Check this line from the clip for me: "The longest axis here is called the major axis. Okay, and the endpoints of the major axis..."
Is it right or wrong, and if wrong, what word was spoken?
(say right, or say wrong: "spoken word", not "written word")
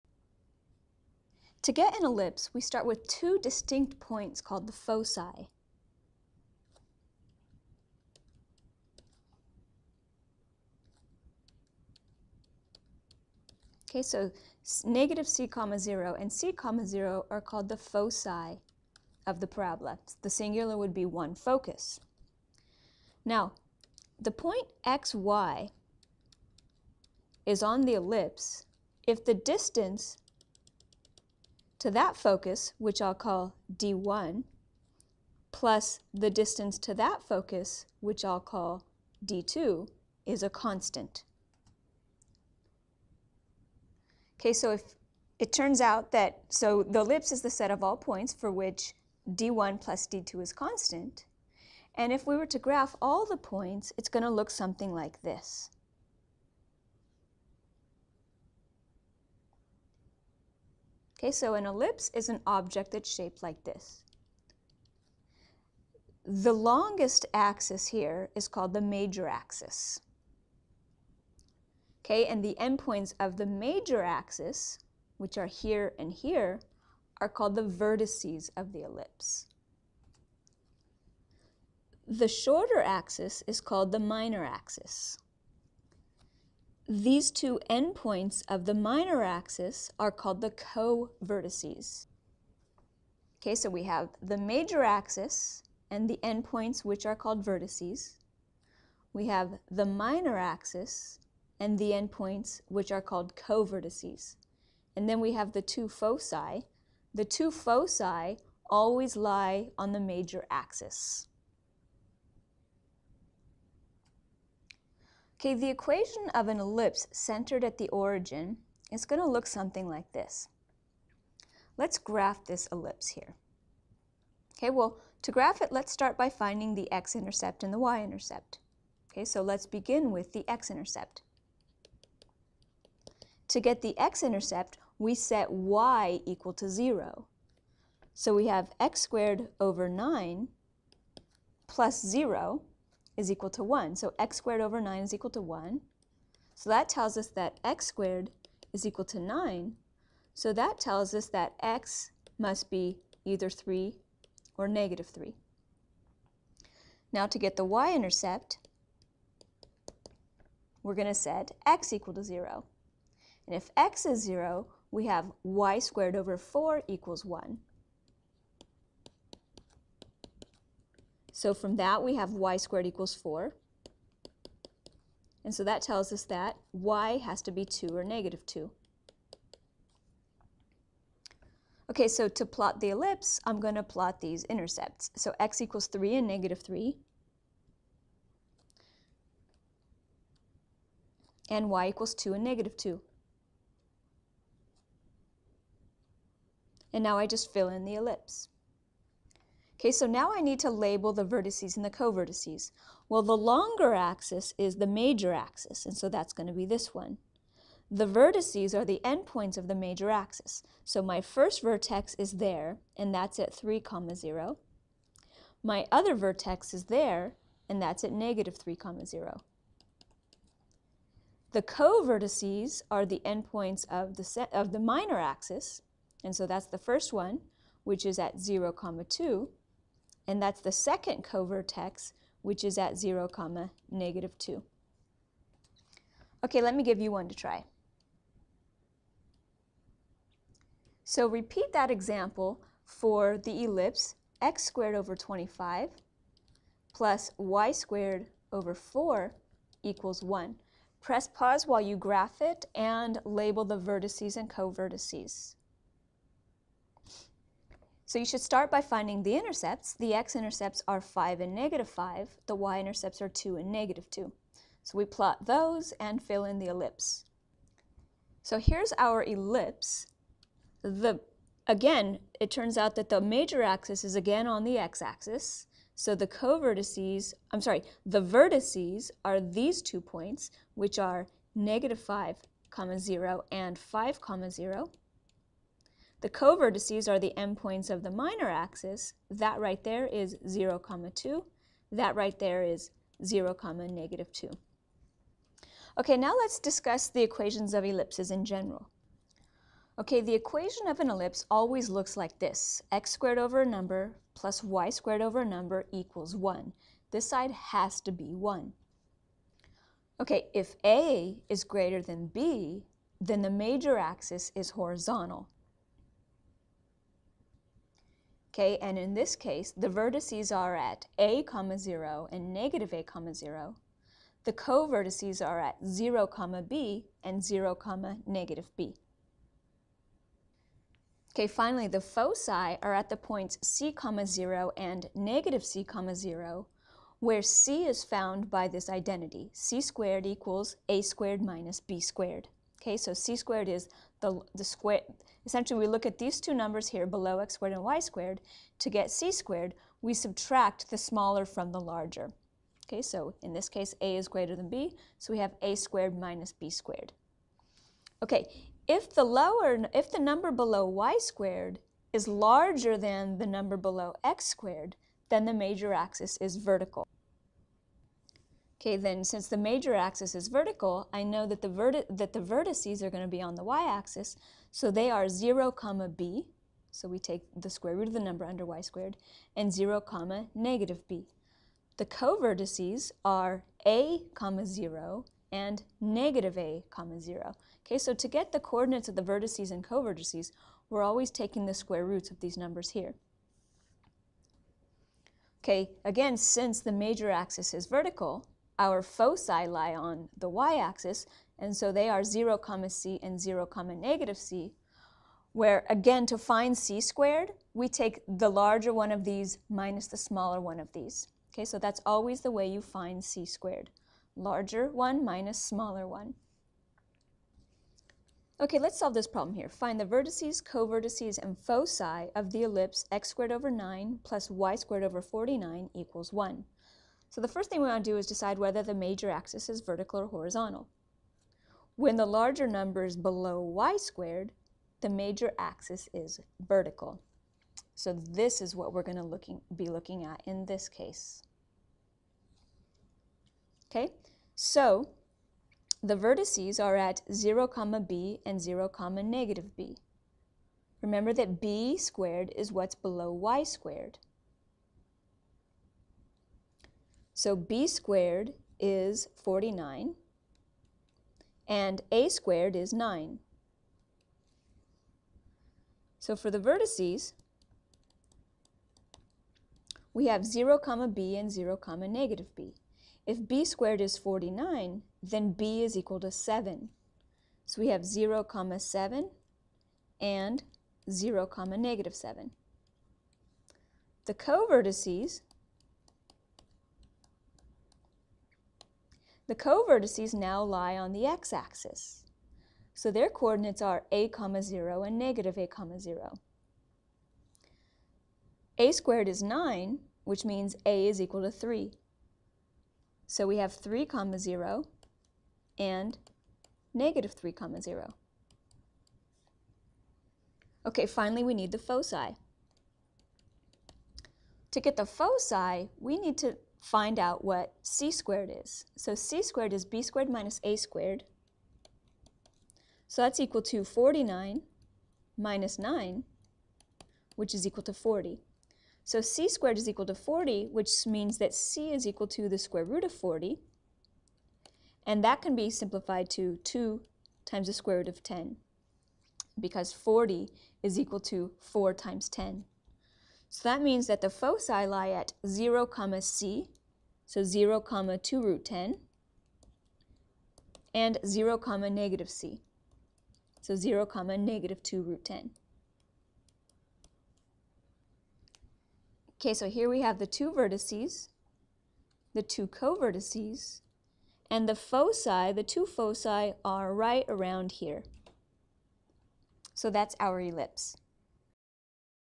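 right.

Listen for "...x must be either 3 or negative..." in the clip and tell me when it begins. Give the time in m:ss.
2:31.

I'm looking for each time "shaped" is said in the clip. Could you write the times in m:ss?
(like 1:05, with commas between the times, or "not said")
1:03.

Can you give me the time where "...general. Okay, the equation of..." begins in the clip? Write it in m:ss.
4:58.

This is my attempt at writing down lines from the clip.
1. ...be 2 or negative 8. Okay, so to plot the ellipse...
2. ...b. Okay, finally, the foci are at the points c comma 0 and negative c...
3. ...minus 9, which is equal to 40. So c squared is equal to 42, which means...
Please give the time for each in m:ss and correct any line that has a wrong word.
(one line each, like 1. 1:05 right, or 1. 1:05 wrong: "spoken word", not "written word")
1. 2:57 wrong: "2", not "8"
2. 5:28 right
3. 8:45 wrong: "40", not "42".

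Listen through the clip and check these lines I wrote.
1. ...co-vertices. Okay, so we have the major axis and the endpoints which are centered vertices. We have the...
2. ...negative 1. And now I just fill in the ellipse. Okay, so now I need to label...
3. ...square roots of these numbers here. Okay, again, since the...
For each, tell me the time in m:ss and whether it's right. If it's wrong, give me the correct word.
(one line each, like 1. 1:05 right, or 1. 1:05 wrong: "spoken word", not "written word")
1. 1:30 wrong: "called", not "centered"
2. 3:12 wrong: "2", not "1"
3. 6:31 right.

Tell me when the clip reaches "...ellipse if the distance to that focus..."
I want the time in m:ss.
0:27.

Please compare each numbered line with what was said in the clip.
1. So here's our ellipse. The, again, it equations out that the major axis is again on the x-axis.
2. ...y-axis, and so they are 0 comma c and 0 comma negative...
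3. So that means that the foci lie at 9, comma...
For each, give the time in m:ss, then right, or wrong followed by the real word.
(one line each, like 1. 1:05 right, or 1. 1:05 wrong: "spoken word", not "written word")
1. 4:28 wrong: "turns", not "equations"
2. 6:40 right
3. 9:03 wrong: "0", not "9".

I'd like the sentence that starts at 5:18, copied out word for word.
Okay, and in this case, the vertices are at a comma 0 and negative a comma 0.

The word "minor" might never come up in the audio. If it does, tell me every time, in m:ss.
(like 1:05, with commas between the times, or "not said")
1:23, 1:28, 1:39, 3:44, 4:48.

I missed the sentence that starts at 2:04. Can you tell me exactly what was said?
Okay, well, to graph it, let's start by finding the x-intercept and the y-intercept.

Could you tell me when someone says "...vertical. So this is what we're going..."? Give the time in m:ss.
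7:16.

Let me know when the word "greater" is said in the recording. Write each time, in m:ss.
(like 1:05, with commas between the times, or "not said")
5:11, 5:54.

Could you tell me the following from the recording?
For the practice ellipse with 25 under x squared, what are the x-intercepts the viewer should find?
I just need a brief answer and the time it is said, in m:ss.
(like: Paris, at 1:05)
5 and -5, at 4:20.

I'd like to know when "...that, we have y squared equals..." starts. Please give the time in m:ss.
2:51.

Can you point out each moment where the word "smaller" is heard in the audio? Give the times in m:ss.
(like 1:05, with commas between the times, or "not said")
5:50, 6:50, 6:55.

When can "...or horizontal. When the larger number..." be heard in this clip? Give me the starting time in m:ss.
7:10.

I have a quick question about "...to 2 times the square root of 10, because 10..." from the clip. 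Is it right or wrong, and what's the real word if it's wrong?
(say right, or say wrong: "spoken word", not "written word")
wrong: "40", not "10".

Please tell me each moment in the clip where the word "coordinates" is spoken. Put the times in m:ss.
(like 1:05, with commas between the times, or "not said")
6:28, 8:13.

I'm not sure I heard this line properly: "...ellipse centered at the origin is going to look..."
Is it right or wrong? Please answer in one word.
right.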